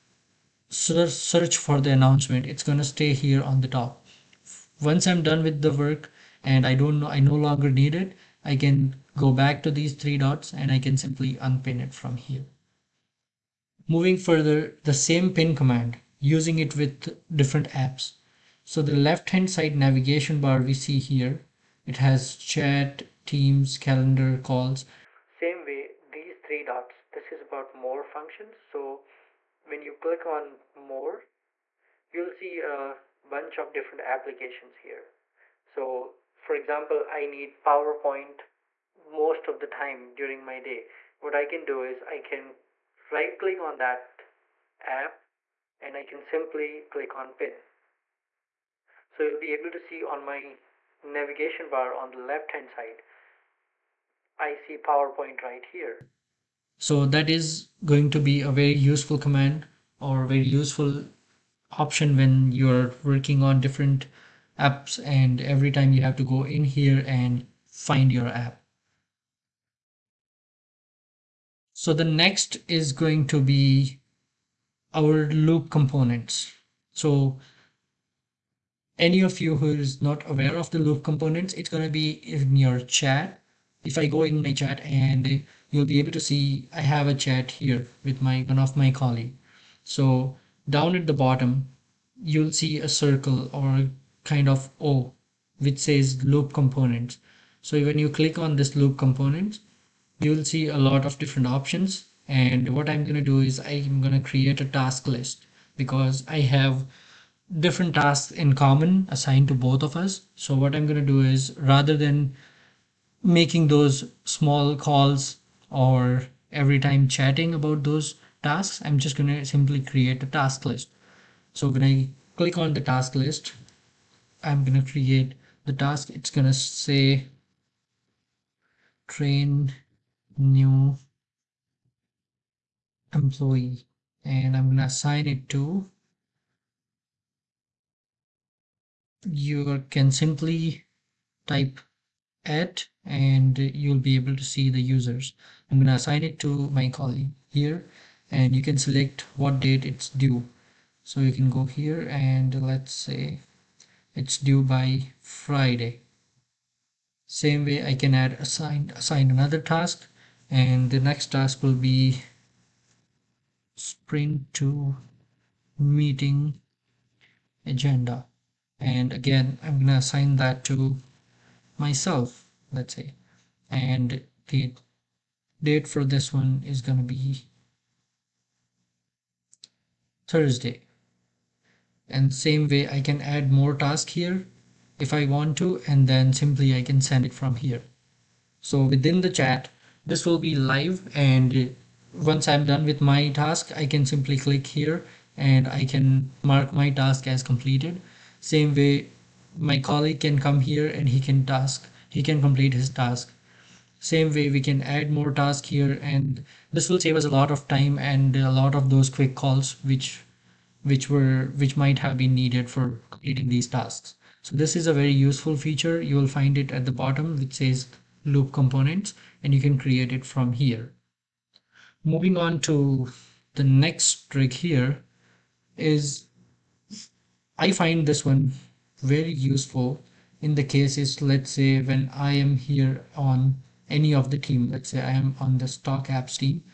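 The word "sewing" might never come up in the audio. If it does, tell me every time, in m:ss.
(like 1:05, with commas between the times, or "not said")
not said.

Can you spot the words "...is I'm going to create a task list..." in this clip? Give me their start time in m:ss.
1:43.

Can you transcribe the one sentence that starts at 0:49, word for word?
So you'll be able to see on my navigation bar on the left hand side, I see PowerPoint right here.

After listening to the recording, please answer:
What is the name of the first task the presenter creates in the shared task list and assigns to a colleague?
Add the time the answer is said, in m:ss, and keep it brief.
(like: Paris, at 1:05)
Train new employee, at 2:09.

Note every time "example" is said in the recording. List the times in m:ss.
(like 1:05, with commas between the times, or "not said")
0:36.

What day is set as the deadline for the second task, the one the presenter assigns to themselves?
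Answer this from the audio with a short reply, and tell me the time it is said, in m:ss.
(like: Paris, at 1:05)
Thursday, at 3:00.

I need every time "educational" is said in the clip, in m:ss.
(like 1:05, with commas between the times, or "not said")
not said.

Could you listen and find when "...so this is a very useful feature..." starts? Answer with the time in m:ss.
3:34.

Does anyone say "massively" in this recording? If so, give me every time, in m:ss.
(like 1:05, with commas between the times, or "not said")
not said.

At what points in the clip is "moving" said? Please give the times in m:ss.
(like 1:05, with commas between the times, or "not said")
0:13, 3:42.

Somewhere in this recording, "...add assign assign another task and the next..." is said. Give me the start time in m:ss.
2:38.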